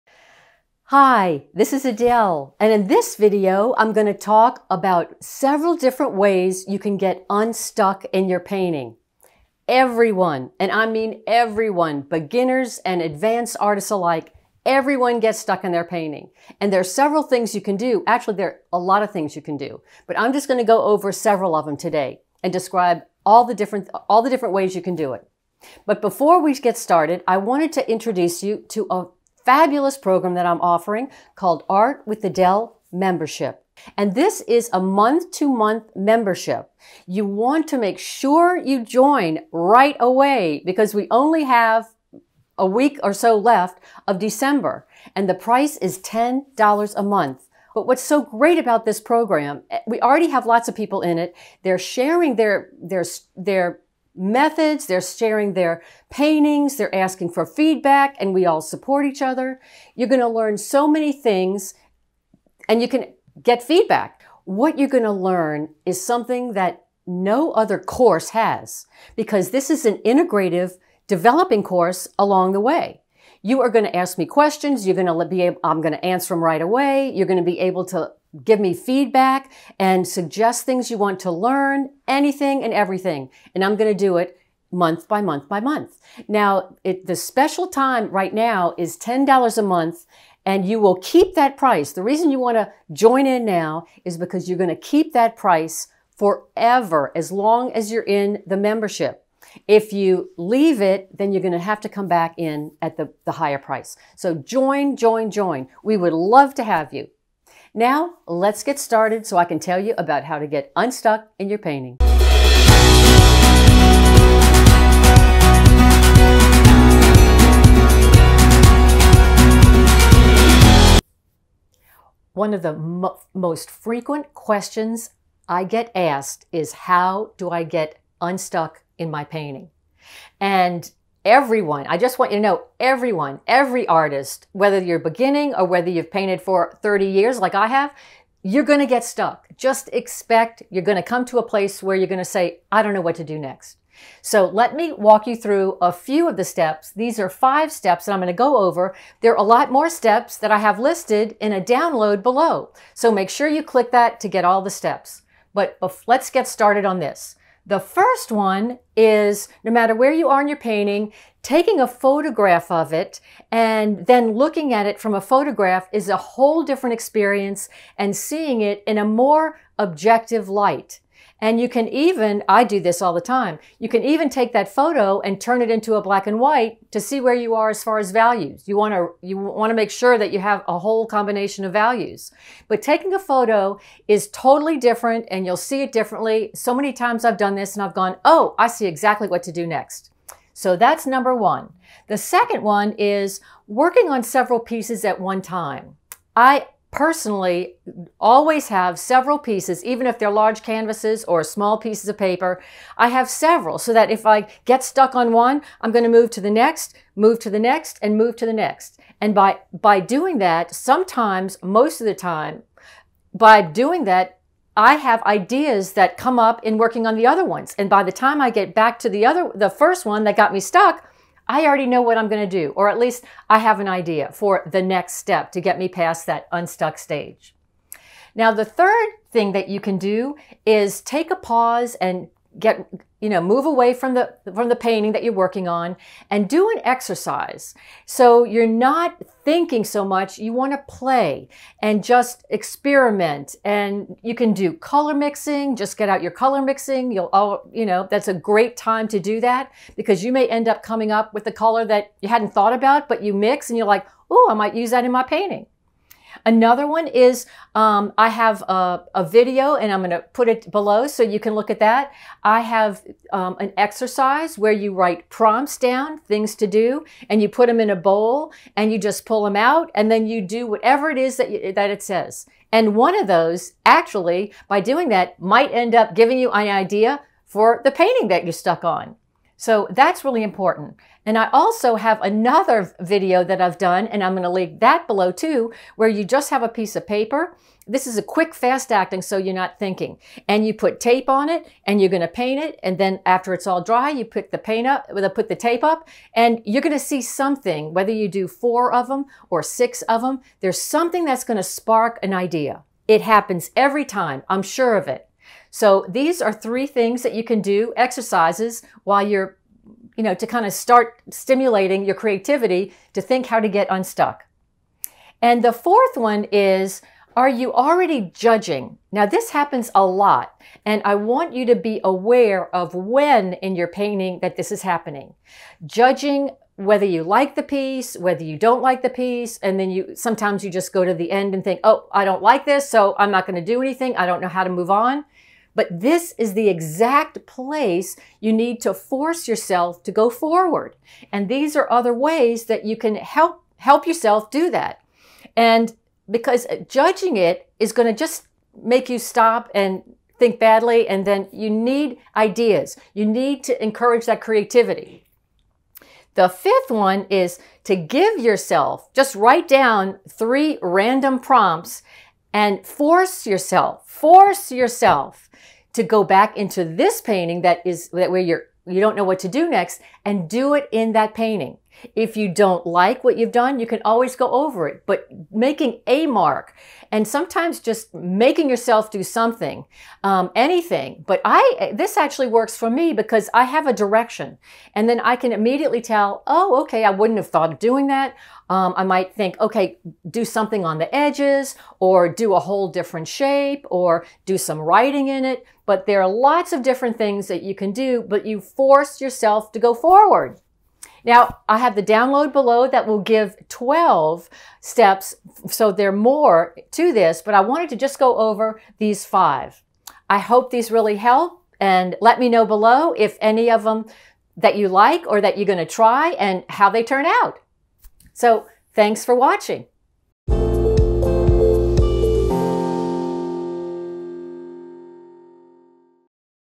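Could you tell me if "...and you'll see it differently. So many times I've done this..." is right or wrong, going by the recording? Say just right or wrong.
right.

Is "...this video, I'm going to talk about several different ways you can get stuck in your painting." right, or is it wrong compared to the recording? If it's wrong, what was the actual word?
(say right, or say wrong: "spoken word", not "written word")
wrong: "unstuck", not "stuck".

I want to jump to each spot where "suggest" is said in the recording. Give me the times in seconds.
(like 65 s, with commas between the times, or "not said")
80 s.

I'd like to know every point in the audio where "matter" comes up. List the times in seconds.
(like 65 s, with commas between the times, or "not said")
159 s.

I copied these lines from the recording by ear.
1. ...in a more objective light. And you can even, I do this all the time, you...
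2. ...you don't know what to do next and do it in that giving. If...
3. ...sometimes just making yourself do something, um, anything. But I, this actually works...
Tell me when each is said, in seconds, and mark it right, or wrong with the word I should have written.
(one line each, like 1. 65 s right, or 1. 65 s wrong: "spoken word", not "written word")
1. 168 s right
2. 368 s wrong: "painting", not "giving"
3. 377 s right.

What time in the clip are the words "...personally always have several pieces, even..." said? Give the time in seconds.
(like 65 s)
196 s.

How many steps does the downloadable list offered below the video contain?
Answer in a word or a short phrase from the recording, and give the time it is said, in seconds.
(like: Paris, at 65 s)
12, at 403 s.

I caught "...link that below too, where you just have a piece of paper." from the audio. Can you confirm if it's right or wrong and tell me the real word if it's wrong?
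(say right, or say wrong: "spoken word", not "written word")
right.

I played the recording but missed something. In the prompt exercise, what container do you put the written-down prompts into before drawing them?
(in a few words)
a bowl.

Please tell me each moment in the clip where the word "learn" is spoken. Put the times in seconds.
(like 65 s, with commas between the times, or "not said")
60 s, 65 s, 81 s.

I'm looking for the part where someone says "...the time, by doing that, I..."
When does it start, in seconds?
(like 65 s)
212 s.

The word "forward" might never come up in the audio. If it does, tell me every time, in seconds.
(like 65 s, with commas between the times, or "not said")
340 s, 399 s.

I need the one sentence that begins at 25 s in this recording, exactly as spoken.
But before we get started, I wanted to introduce you to a fabulous program that I'm offering called Art with Adele membership.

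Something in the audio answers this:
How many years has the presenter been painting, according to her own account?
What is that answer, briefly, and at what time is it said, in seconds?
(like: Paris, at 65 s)
30, at 136 s.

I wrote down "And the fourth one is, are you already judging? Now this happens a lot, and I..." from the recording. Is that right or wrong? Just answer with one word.
right.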